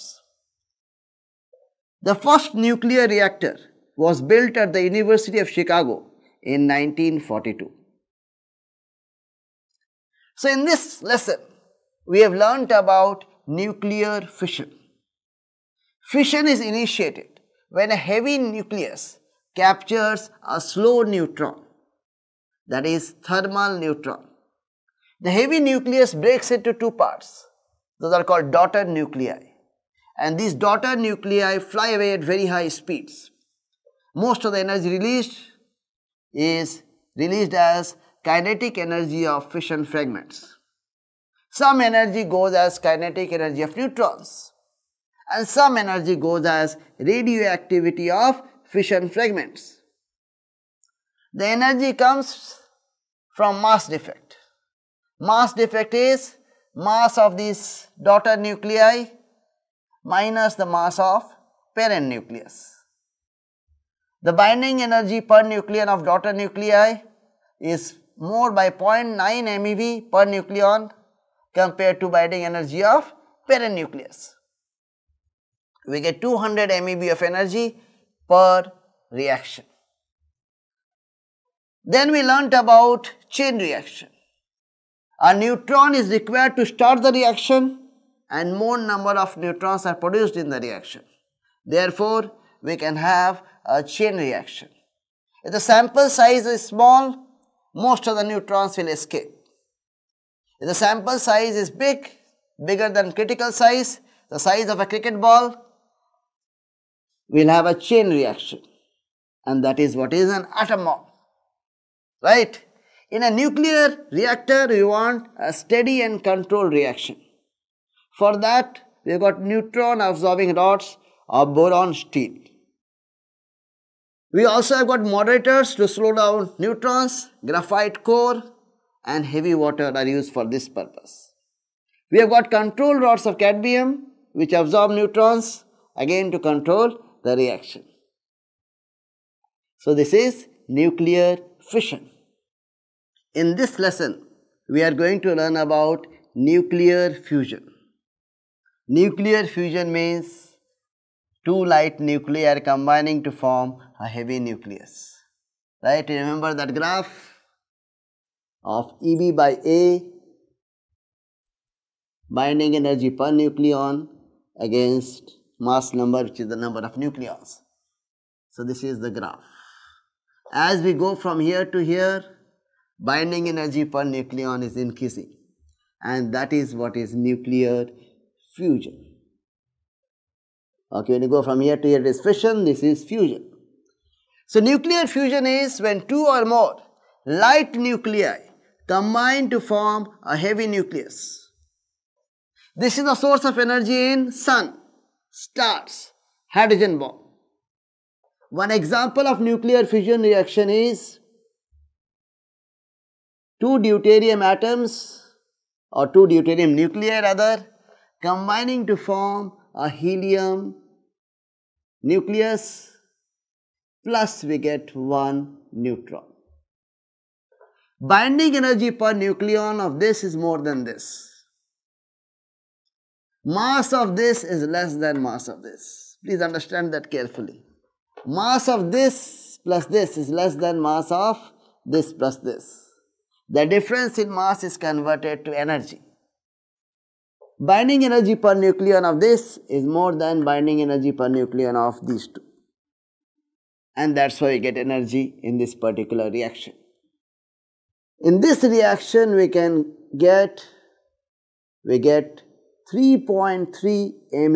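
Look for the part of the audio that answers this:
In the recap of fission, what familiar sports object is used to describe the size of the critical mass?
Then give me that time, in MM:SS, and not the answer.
01:44.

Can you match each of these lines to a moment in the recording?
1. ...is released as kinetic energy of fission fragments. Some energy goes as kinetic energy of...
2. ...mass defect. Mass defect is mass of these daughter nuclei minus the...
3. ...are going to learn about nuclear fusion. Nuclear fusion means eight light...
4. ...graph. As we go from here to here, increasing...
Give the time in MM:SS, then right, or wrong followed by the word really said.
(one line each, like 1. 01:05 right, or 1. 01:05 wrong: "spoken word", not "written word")
1. 00:36 right
2. 00:53 right
3. 02:24 wrong: "two", not "eight"
4. 02:49 wrong: "binding", not "increasing".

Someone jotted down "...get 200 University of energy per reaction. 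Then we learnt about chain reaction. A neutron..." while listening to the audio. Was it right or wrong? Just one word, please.
wrong.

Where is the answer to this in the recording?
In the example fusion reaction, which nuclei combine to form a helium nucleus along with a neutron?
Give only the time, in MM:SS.
03:26.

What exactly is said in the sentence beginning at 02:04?
We also have got moderators to slow down neutrons, graphite core, and heavy water are used for this purpose.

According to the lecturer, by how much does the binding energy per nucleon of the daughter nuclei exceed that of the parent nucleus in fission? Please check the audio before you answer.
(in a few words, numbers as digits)
0.9 MeV per nucleon.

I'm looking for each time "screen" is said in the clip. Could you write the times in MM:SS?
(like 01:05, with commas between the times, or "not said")
not said.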